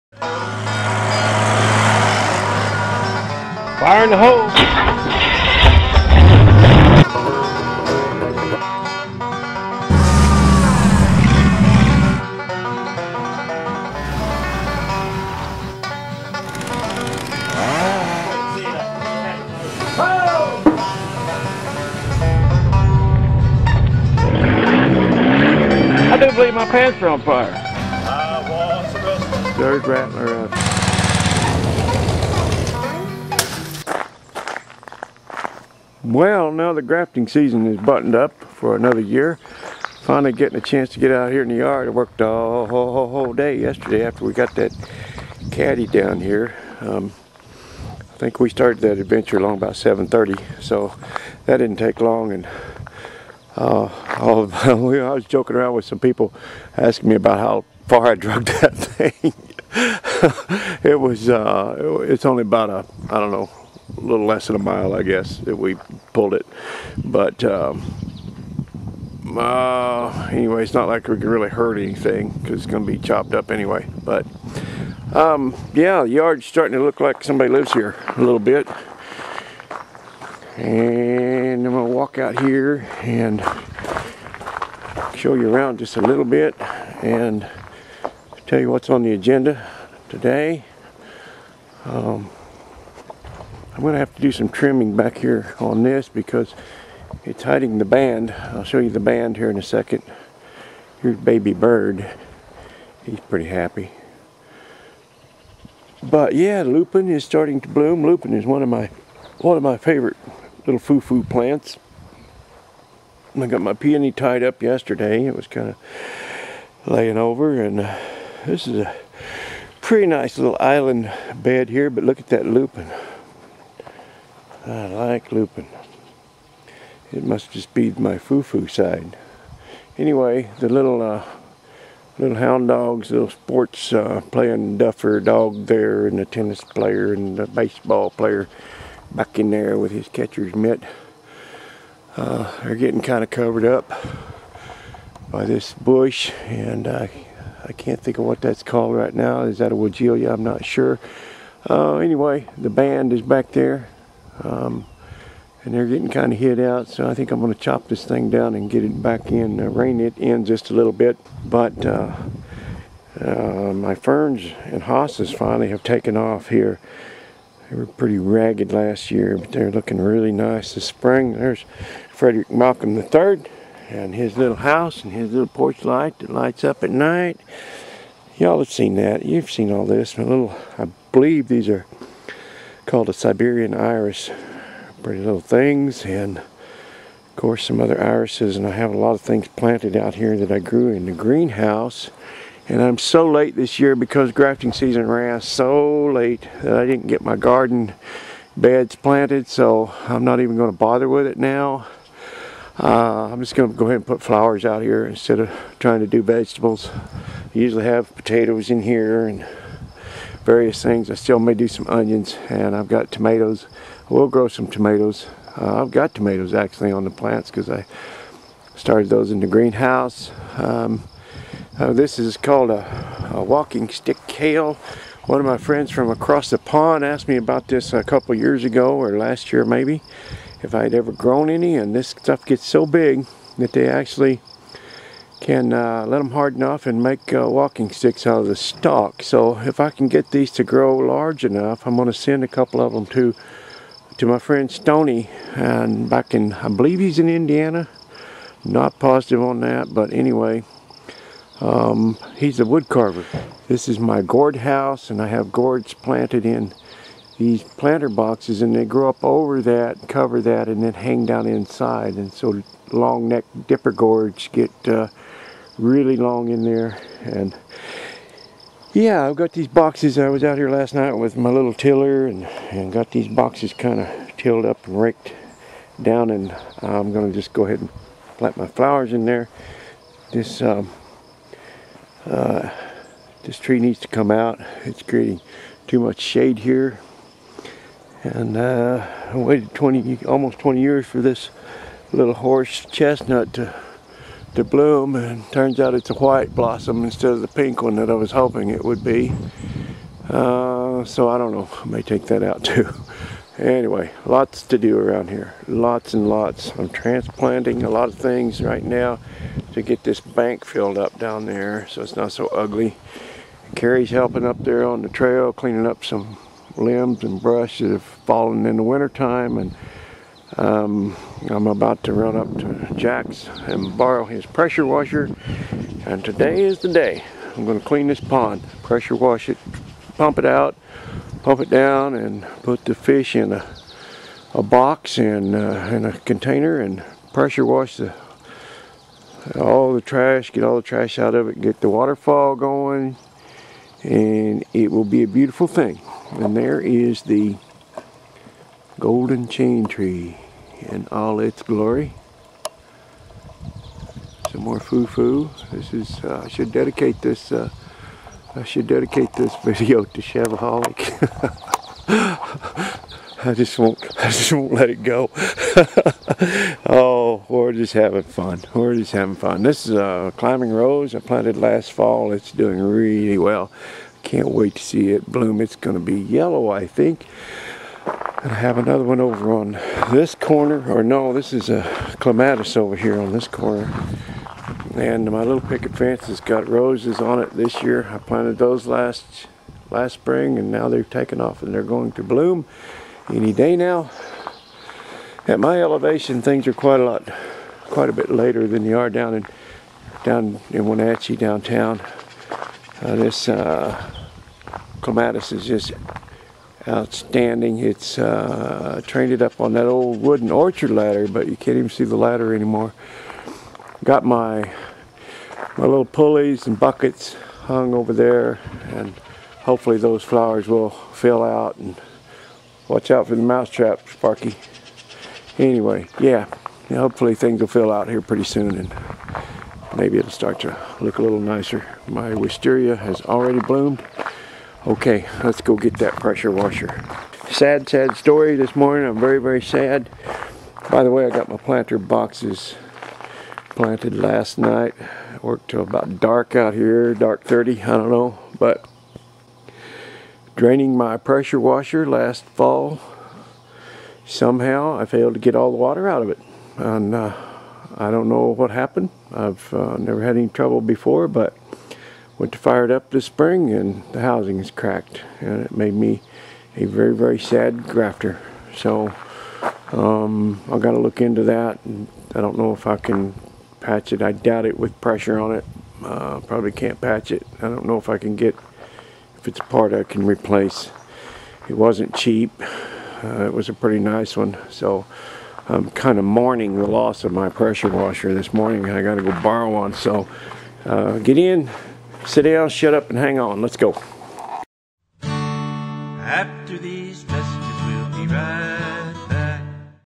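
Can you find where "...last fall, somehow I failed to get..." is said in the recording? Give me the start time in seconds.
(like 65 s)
452 s.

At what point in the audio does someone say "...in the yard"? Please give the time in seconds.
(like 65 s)
41 s.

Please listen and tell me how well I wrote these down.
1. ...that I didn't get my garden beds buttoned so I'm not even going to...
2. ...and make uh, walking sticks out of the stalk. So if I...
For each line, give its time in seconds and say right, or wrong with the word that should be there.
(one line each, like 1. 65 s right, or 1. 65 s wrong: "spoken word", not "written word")
1. 196 s wrong: "planted", not "buttoned"
2. 236 s right.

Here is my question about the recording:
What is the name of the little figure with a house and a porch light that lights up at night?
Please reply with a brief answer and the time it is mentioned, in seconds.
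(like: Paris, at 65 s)
Frederick Malcolm III, at 172 s.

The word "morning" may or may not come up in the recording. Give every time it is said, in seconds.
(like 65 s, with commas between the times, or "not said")
438 s, 488 s.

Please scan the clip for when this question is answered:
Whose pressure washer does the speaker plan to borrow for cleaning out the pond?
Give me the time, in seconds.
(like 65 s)
322 s.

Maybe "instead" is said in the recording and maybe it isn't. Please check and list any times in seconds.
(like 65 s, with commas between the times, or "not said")
205 s, 297 s.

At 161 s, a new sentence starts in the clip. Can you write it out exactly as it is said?
But uh, uh, my ferns and hostas finally have taken off here.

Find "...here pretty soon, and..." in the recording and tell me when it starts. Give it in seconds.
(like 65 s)
428 s.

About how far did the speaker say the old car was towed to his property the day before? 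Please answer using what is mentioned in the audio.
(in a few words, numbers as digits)
less than a mile.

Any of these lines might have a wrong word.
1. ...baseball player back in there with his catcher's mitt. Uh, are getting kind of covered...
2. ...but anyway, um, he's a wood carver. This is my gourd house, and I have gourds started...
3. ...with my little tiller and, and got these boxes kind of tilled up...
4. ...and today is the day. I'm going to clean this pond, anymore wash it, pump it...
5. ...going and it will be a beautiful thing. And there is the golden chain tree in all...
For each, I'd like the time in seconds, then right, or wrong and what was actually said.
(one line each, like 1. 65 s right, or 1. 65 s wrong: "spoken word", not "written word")
1. 137 s right
2. 249 s wrong: "planted", not "started"
3. 271 s right
4. 326 s wrong: "pressure", not "anymore"
5. 342 s right.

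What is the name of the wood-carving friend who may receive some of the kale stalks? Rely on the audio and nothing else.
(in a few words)
Stony.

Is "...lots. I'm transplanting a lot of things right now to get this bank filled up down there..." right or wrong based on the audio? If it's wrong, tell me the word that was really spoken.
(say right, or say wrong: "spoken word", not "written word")
right.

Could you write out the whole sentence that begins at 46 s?
Um, I think we started that adventure along about 7.30, so that didn't take long.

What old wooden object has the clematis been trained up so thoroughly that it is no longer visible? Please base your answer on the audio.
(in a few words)
Orchard ladder.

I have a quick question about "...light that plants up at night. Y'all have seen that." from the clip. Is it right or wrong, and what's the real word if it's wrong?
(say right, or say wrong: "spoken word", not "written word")
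wrong: "lights", not "plants".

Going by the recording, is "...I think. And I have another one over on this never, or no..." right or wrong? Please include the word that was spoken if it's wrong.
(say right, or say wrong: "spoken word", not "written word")
wrong: "corner", not "never".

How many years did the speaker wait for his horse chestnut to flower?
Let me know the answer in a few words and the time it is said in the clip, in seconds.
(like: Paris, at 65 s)
Almost 20, at 290 s.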